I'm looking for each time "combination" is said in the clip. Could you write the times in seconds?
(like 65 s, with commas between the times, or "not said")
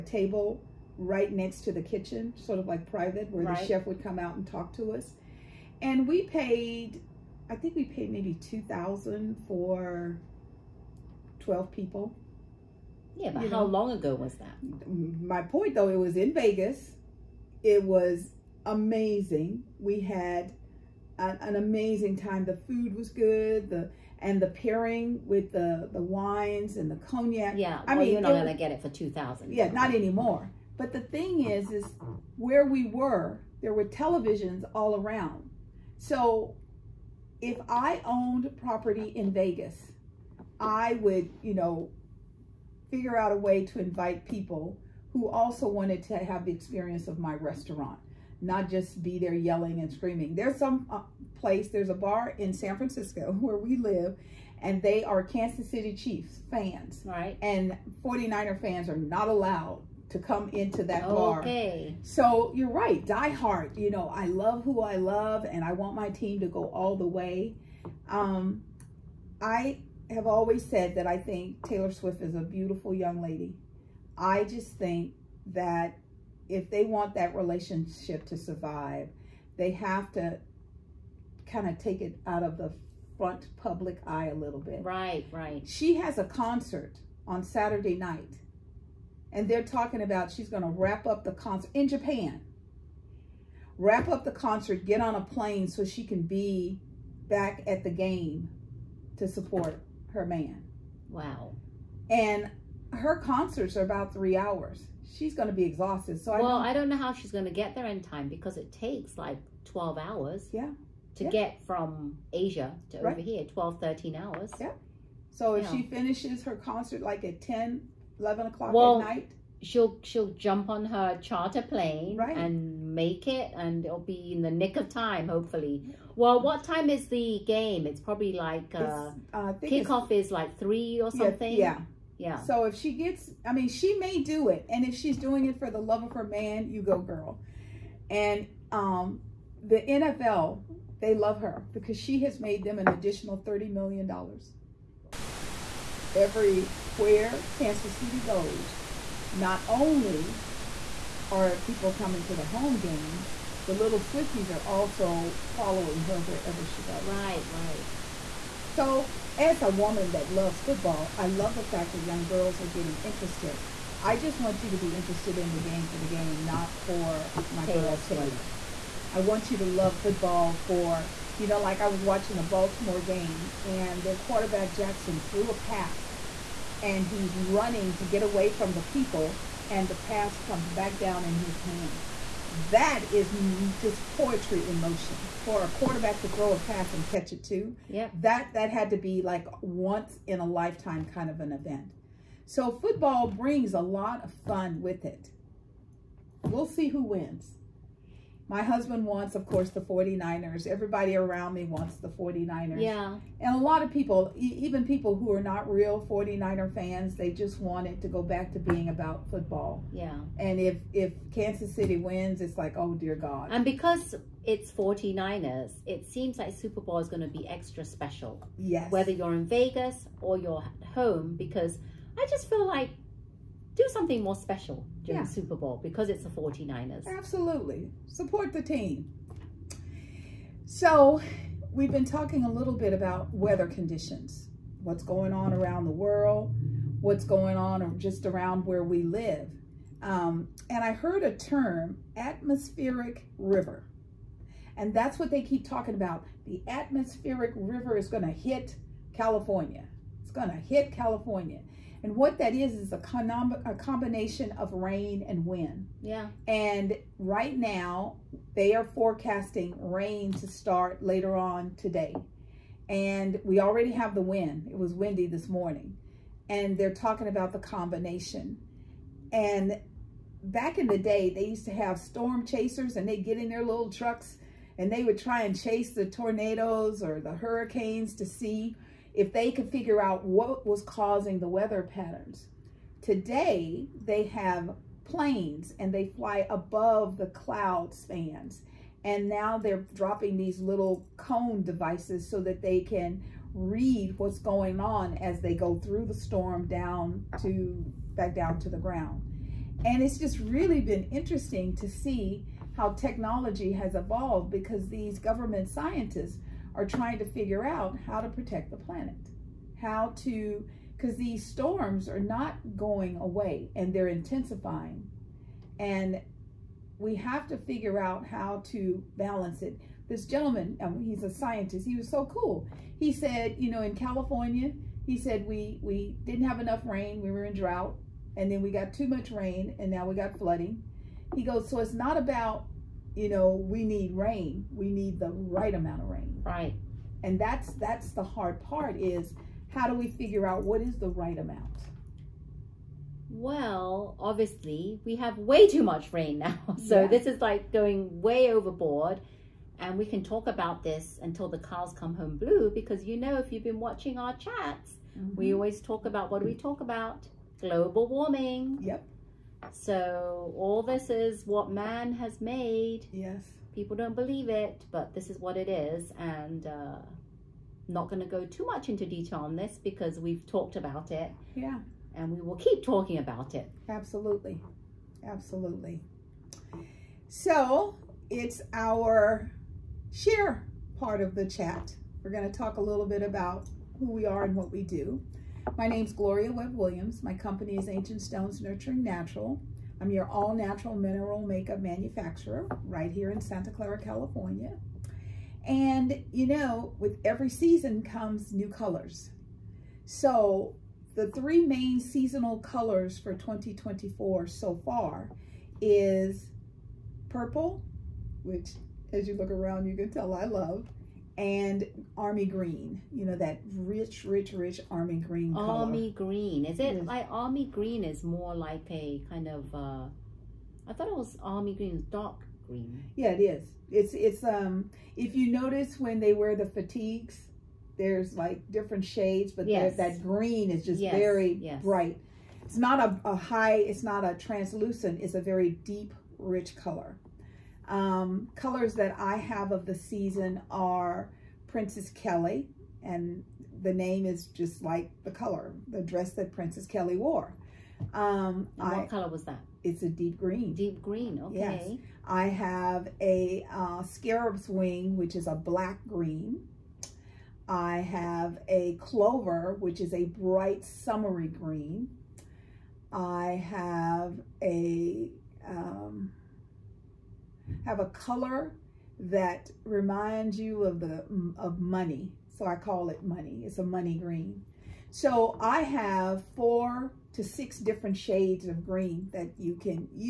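253 s, 267 s.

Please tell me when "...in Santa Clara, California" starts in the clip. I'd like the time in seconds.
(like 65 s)
393 s.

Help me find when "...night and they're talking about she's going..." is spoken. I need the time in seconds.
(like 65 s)
87 s.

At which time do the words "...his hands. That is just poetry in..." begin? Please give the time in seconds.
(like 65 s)
181 s.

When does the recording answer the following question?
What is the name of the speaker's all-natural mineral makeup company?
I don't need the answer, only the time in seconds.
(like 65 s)
387 s.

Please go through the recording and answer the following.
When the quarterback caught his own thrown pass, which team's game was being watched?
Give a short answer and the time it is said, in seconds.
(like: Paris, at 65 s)
Baltimore, at 172 s.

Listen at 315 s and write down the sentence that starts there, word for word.
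And we have to figure out how to balance it.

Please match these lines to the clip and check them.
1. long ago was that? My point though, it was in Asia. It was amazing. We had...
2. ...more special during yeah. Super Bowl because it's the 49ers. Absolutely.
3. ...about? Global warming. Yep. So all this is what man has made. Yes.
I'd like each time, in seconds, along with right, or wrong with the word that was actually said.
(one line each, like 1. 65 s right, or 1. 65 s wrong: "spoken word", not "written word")
1. 13 s wrong: "Vegas", not "Asia"
2. 224 s right
3. 356 s right.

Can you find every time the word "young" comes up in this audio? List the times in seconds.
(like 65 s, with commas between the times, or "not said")
72 s, 162 s.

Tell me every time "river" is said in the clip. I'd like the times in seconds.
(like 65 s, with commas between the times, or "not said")
243 s, 247 s.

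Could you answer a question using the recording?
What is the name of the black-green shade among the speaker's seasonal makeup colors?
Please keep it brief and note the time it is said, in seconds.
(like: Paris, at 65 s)
Scarab's wing, at 454 s.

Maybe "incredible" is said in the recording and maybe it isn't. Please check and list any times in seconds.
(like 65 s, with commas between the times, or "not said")
not said.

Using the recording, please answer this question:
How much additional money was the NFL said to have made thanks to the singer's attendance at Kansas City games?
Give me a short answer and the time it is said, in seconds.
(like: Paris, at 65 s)
$30 million, at 143 s.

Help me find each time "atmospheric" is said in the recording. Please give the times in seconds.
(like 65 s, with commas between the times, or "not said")
242 s, 246 s.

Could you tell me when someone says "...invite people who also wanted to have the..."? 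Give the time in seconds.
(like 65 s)
43 s.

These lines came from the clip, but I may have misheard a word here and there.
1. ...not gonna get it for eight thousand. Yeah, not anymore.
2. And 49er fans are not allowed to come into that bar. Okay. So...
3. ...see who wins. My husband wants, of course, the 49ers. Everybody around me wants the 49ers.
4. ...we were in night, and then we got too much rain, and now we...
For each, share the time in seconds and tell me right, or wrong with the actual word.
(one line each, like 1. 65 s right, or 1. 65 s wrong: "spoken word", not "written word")
1. 28 s wrong: "two", not "eight"
2. 57 s right
3. 196 s right
4. 327 s wrong: "drought", not "night".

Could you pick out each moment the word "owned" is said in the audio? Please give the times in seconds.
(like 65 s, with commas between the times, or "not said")
38 s.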